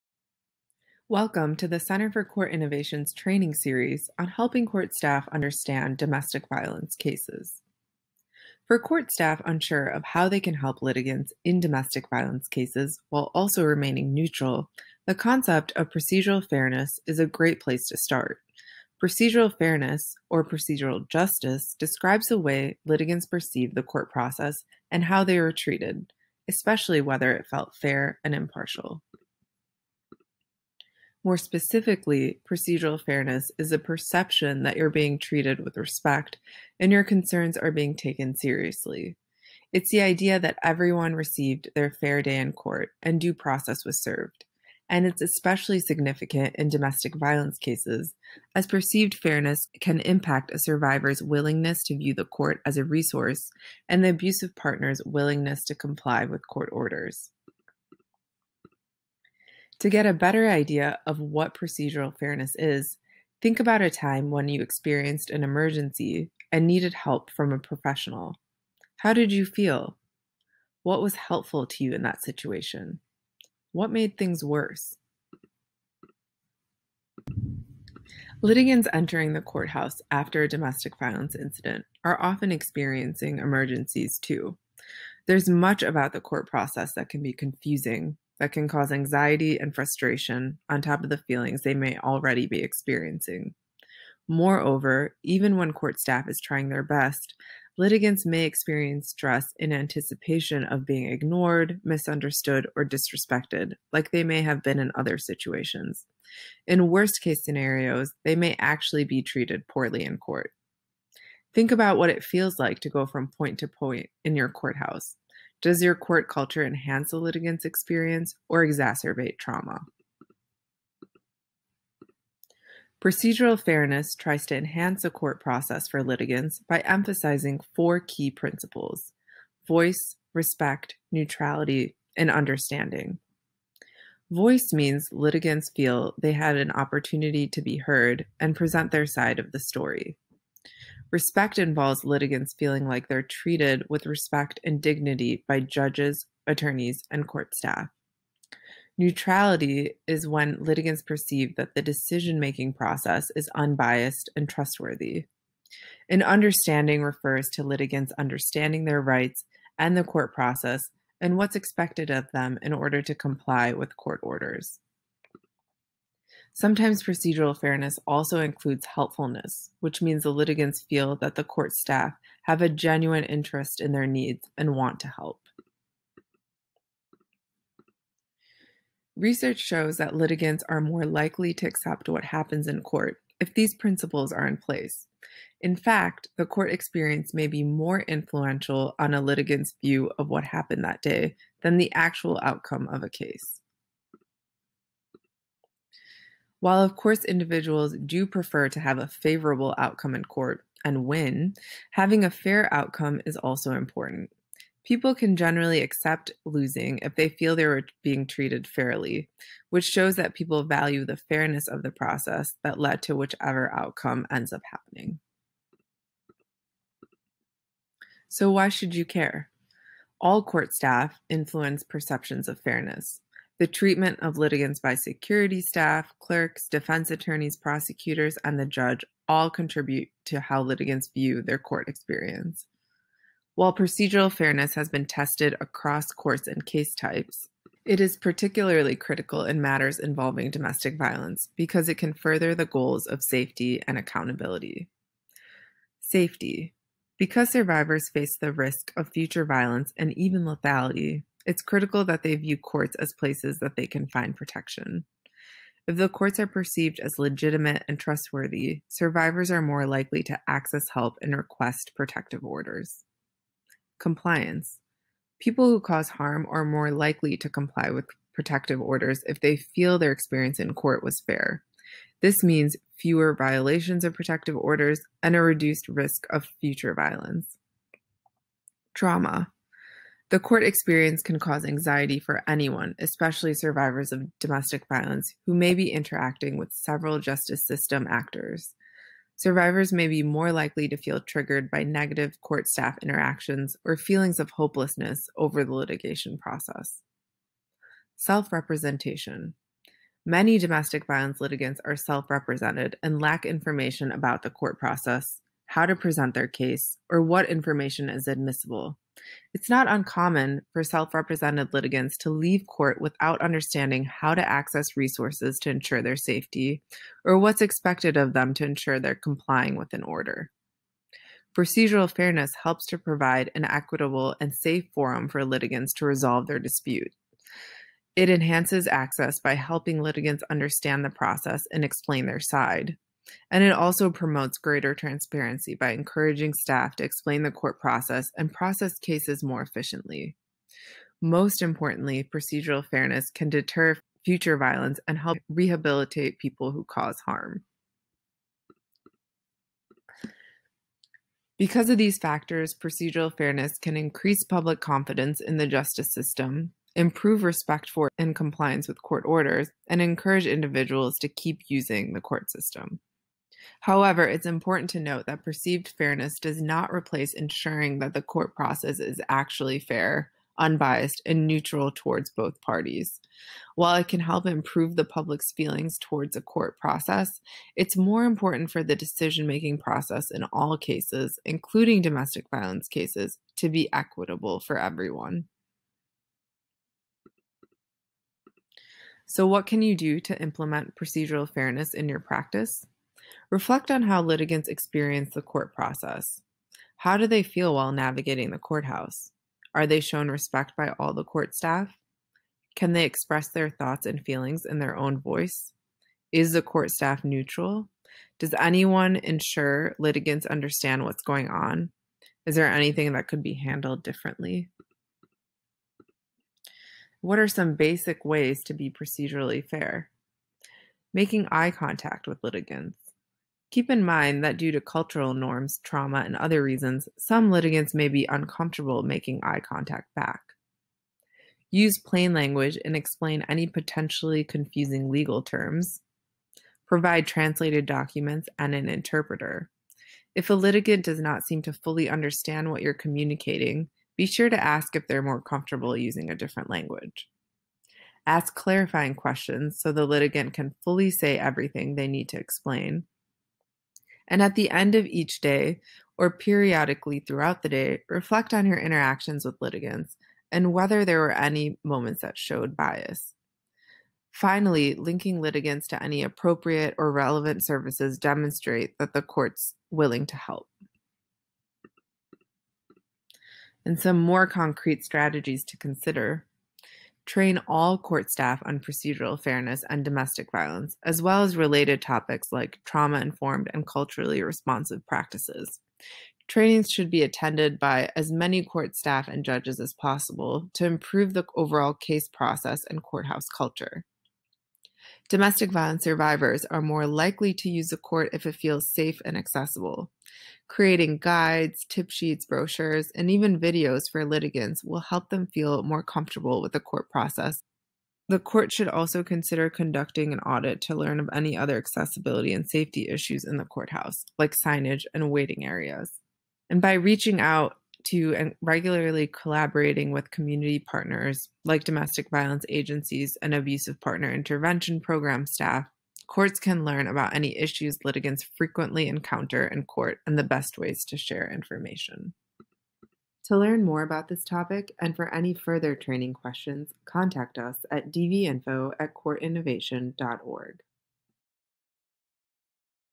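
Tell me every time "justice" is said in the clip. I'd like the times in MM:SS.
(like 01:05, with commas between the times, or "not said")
00:21, 04:47, 05:55.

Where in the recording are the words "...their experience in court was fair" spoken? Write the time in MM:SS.
04:29.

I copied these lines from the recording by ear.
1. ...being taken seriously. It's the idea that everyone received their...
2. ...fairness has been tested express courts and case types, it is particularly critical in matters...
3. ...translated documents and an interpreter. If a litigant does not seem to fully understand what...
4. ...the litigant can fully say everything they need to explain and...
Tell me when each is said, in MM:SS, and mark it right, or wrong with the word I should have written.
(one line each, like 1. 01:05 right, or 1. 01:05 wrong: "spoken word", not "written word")
1. 00:37 right
2. 03:54 wrong: "across", not "express"
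3. 07:17 right
4. 07:29 right.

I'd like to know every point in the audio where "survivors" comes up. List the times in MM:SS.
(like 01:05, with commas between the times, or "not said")
00:50, 04:07, 04:18, 04:43, 04:49, 08:16.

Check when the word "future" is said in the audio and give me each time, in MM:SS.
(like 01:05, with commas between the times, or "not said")
04:09, 04:36, 05:44.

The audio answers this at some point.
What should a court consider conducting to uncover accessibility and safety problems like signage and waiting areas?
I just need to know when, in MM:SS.
08:30.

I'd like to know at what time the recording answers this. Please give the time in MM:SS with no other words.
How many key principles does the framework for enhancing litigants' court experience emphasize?
02:07.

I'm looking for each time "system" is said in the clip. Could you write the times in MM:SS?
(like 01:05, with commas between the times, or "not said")
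04:47, 05:56, 06:02.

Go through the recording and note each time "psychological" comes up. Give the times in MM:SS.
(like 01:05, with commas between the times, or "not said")
not said.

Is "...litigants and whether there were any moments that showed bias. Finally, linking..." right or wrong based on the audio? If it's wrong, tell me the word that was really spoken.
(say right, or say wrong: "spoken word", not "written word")
right.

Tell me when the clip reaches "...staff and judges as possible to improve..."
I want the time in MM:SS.
08:08.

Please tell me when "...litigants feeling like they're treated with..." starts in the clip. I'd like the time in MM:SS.
02:22.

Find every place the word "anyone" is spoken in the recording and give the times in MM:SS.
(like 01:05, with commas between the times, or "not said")
04:42, 06:48.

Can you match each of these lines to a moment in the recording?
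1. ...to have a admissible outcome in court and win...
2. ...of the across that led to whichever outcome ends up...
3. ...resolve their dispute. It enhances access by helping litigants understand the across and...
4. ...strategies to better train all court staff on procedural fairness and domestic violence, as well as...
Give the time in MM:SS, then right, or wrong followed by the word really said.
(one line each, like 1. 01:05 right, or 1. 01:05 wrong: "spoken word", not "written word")
1. 03:18 wrong: "favorable", not "admissible"
2. 03:31 wrong: "process", not "across"
3. 05:26 wrong: "process", not "across"
4. 07:55 wrong: "consider", not "better".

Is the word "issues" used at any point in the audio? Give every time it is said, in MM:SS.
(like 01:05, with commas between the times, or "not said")
08:33, 08:47.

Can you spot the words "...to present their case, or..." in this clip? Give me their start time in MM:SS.
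05:05.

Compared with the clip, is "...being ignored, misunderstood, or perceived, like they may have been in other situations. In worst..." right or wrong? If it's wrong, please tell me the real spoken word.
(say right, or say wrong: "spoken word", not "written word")
wrong: "disrespected", not "perceived".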